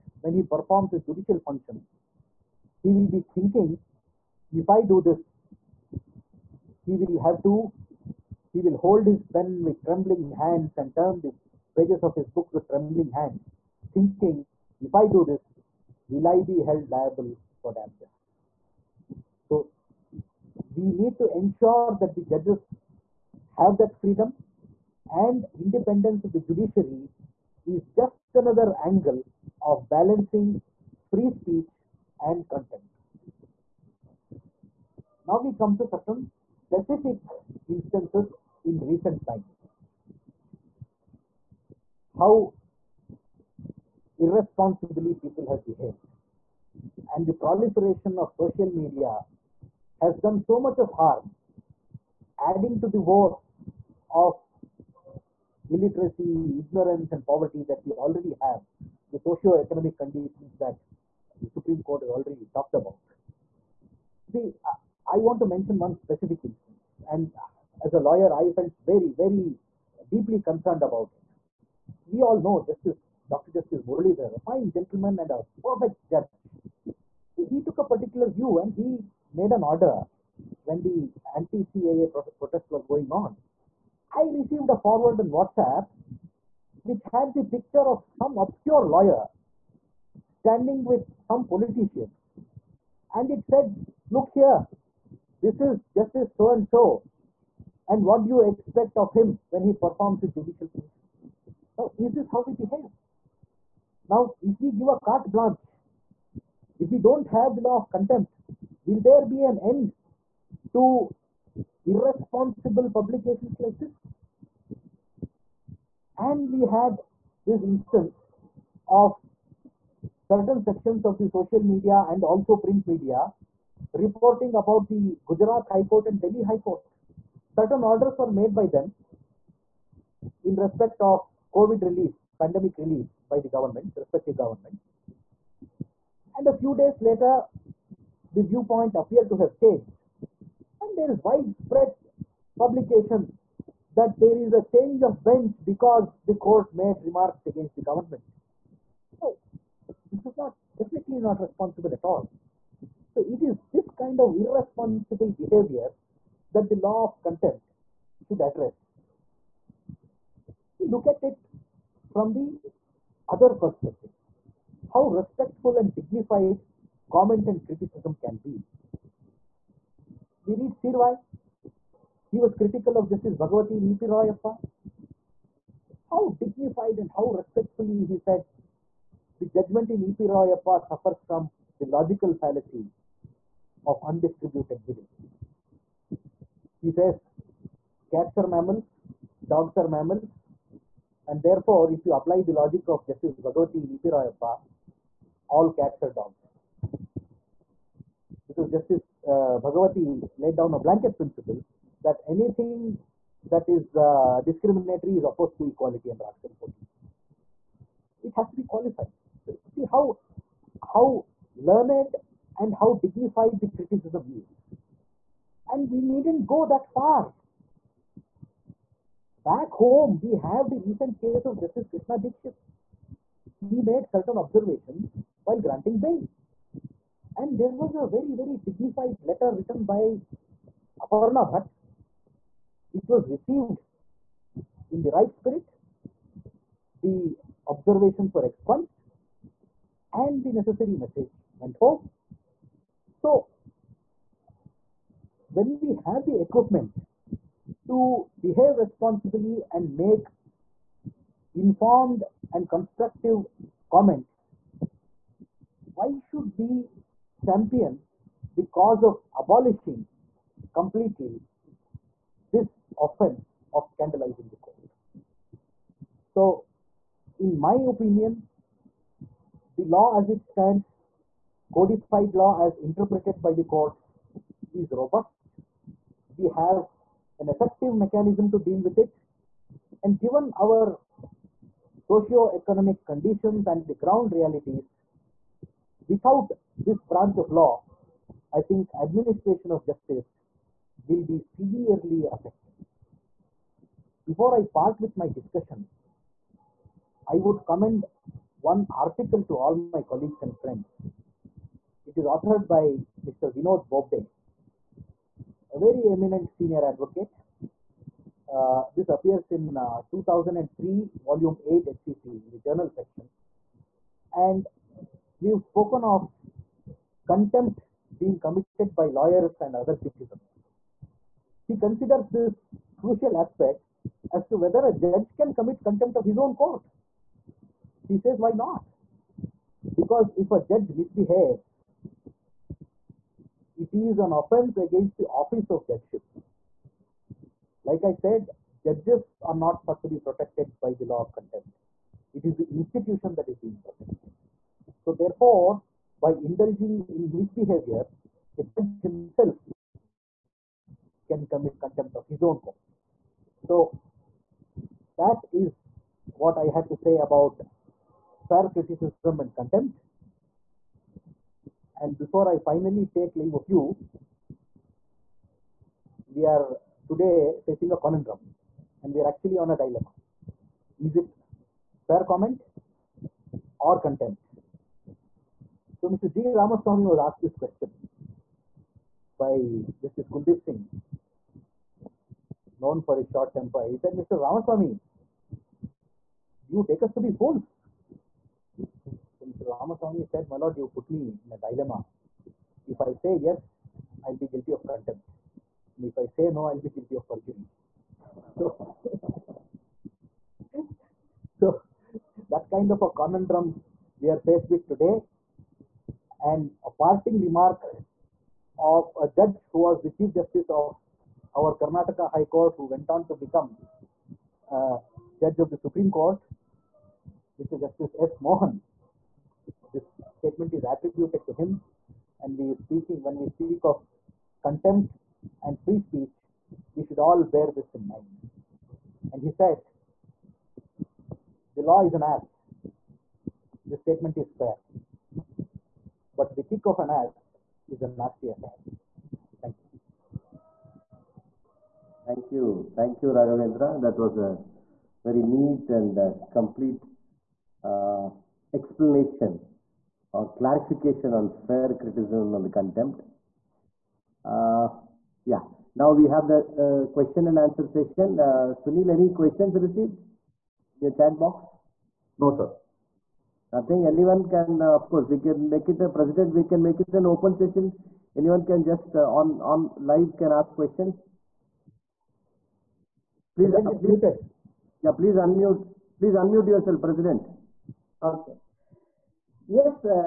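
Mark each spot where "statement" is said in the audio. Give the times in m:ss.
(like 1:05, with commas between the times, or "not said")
7:00, 7:14.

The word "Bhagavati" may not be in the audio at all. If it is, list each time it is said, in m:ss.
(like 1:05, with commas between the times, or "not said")
2:53, 3:13, 3:19.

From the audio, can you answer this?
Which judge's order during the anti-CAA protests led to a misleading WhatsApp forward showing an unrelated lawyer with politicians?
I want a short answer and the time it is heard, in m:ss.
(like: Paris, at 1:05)
Justice Muralidhar, at 1:13.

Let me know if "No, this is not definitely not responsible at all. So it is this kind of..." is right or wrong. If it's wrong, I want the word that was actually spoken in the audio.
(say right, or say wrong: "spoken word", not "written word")
right.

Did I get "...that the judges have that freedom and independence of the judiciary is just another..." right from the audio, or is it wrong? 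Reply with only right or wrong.
right.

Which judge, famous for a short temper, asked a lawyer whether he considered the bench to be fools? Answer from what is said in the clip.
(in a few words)
Justice Kuldeep Singh.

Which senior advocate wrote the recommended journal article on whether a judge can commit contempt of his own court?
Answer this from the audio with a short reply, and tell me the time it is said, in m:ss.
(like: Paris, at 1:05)
Vinod Bobde, at 5:03.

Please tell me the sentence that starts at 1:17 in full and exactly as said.
He took a particular view and he made an order when the anti-CAA protests were going on.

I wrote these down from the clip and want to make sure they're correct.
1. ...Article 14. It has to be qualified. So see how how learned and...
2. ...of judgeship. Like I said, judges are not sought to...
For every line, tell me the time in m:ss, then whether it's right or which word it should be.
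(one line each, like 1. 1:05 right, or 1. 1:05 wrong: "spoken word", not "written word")
1. 3:26 right
2. 5:35 right.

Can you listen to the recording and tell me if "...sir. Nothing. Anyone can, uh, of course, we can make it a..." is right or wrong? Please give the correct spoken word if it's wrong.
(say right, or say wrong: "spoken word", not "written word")
right.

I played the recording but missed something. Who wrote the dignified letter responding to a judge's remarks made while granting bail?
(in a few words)
Aparna Bhatt.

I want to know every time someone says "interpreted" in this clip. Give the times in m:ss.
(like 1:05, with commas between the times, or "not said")
4:32.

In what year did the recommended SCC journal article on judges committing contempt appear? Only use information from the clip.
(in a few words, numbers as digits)
2003.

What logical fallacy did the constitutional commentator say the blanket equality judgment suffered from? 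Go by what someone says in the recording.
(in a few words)
Undistributed middle.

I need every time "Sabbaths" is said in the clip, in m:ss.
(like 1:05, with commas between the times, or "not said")
not said.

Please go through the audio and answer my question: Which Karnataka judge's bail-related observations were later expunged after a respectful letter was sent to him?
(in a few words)
Justice Krishna Dixit.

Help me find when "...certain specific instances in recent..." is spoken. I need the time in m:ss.
0:35.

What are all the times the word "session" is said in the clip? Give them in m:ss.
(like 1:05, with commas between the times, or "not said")
7:37, 7:47.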